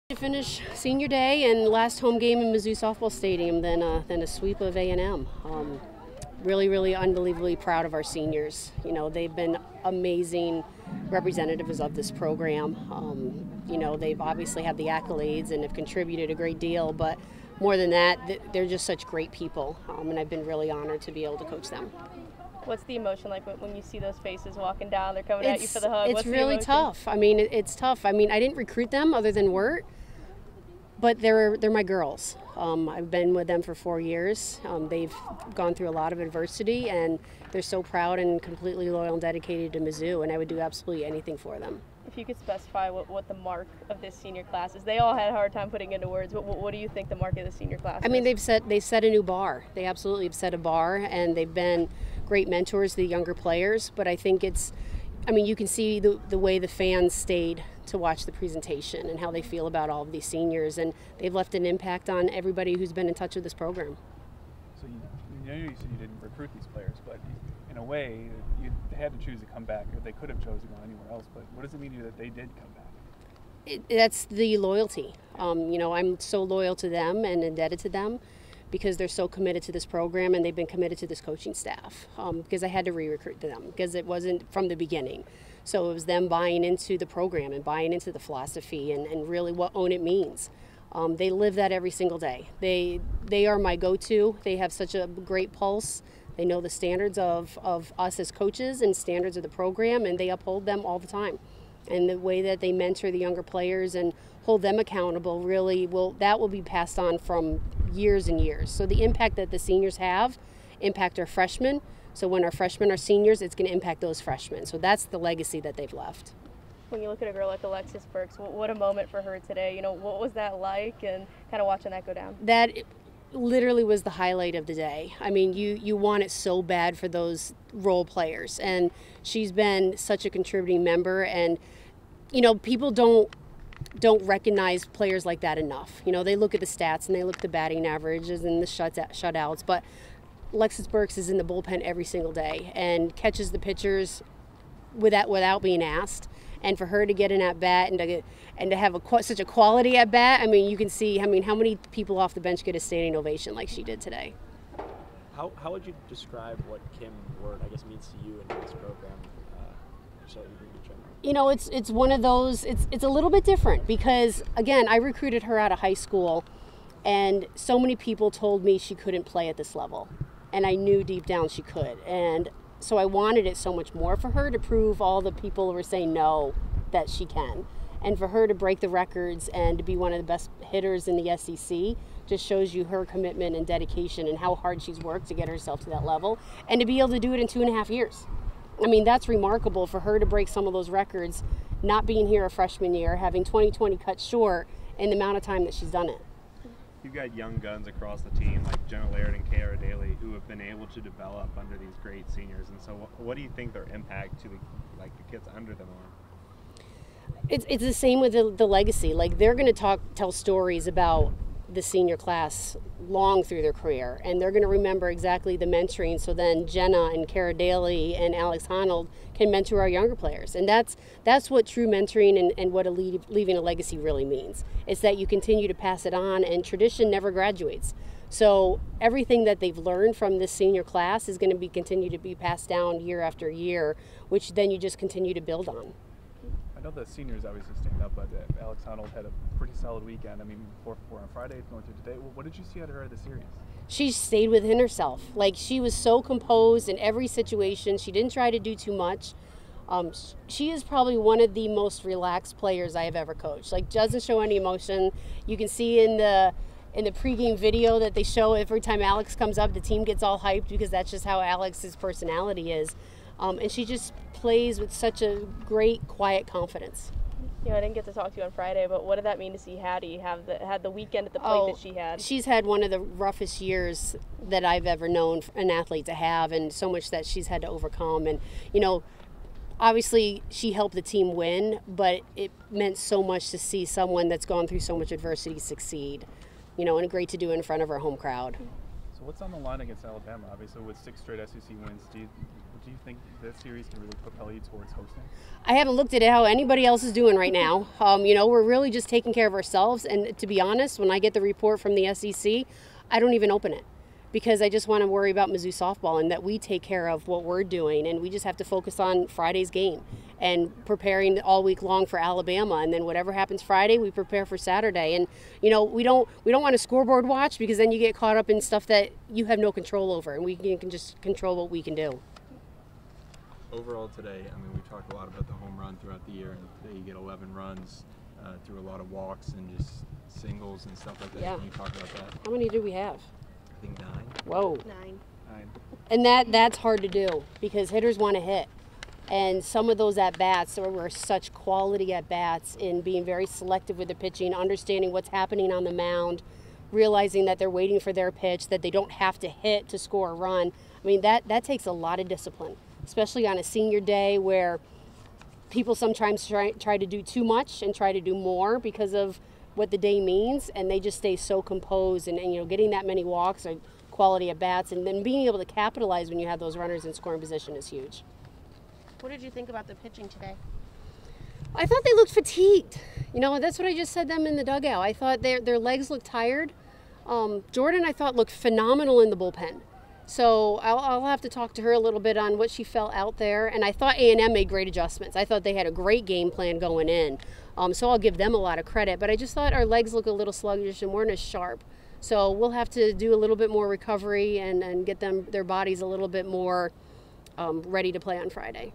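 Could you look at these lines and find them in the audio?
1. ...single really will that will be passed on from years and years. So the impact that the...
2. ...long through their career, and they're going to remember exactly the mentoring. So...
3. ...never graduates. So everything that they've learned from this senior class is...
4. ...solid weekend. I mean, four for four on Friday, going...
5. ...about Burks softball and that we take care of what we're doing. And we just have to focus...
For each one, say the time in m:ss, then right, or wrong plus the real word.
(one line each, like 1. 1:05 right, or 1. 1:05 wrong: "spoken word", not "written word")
1. 1:44 wrong: "accountable", not "single"
2. 3:33 right
3. 3:47 right
4. 3:59 right
5. 5:05 wrong: "Mizzou", not "Burks".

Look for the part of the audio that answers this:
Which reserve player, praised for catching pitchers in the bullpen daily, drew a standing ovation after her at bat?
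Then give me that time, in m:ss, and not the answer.
1:57.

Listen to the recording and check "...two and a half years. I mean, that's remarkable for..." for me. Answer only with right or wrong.
right.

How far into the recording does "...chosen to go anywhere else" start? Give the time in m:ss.
1:10.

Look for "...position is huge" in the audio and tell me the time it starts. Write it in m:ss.
6:07.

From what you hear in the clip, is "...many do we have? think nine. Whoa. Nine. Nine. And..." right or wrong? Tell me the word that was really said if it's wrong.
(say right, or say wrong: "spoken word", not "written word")
right.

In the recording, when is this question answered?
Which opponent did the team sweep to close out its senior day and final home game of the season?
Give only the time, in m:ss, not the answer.
0:04.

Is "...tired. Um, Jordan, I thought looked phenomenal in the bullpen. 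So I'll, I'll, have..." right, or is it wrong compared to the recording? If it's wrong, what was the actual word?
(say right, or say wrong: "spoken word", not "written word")
right.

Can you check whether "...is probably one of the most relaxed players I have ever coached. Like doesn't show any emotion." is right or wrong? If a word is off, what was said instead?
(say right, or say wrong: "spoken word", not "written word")
right.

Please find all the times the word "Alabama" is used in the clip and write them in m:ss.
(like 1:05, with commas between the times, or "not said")
4:50, 5:12.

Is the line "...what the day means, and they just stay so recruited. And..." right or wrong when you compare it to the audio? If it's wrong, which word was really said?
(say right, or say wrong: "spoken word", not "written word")
wrong: "composed", not "recruited".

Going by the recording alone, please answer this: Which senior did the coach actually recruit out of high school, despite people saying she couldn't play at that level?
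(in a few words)
Kim Wert.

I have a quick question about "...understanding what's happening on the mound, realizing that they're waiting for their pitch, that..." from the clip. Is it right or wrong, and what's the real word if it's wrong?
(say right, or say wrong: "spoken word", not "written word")
right.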